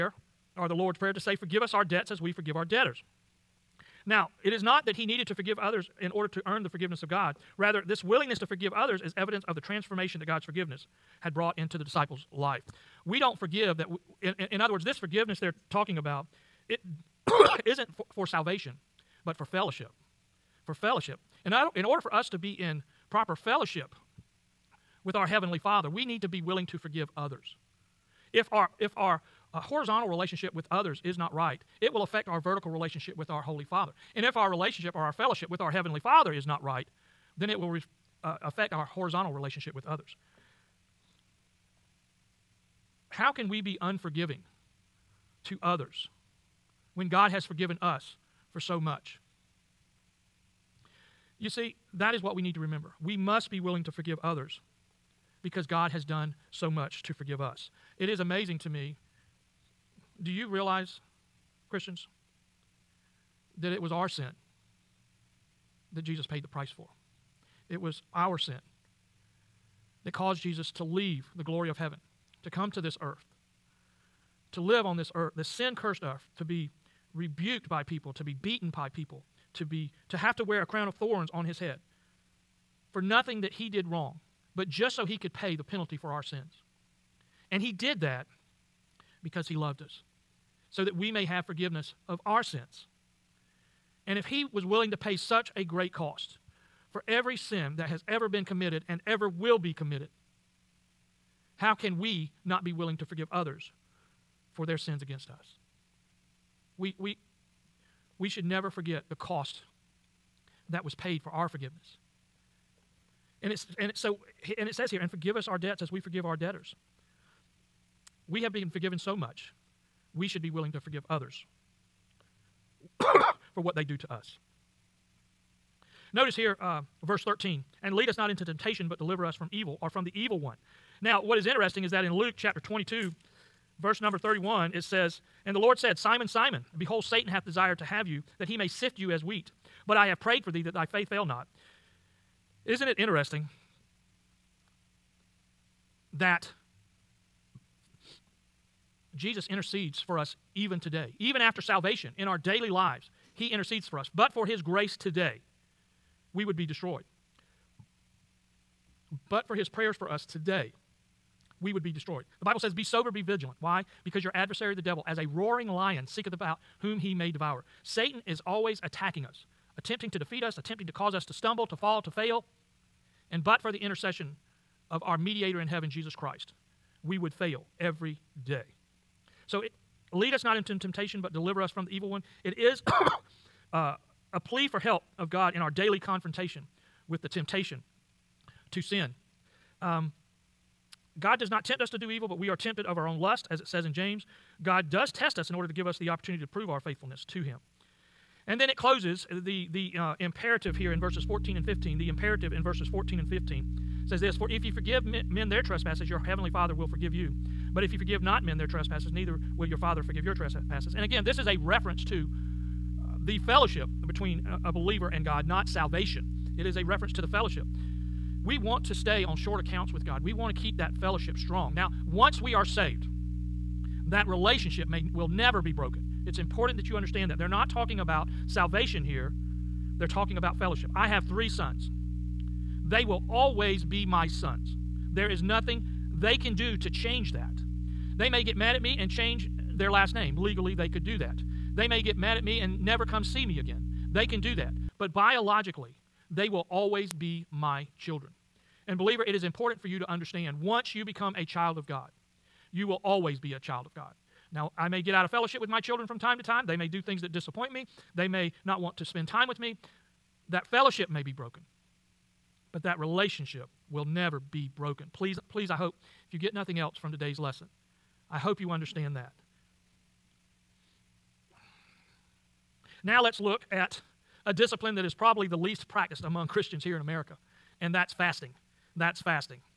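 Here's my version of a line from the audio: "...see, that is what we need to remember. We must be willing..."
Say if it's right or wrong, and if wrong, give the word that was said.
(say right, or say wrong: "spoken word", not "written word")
right.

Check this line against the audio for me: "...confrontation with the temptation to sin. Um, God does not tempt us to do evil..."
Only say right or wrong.
right.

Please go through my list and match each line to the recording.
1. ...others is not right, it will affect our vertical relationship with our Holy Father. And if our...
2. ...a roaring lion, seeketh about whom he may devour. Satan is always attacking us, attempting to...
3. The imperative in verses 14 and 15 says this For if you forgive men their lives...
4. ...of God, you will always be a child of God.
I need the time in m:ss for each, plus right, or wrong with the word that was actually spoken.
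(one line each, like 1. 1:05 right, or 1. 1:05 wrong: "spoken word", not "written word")
1. 0:30 right
2. 2:45 right
3. 3:21 wrong: "trespasses", not "lives"
4. 4:11 right.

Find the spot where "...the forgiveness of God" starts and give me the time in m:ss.
0:06.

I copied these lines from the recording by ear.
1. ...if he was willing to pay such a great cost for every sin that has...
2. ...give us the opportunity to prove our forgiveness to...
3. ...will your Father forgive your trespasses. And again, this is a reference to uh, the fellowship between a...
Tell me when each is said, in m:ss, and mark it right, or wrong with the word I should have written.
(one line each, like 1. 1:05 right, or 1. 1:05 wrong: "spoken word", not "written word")
1. 1:34 right
2. 3:15 wrong: "faithfulness", not "forgiveness"
3. 3:29 right.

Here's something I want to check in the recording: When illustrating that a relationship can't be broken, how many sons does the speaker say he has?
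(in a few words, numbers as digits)
3.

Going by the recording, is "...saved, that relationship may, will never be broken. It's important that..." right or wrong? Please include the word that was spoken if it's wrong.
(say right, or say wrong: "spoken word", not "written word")
right.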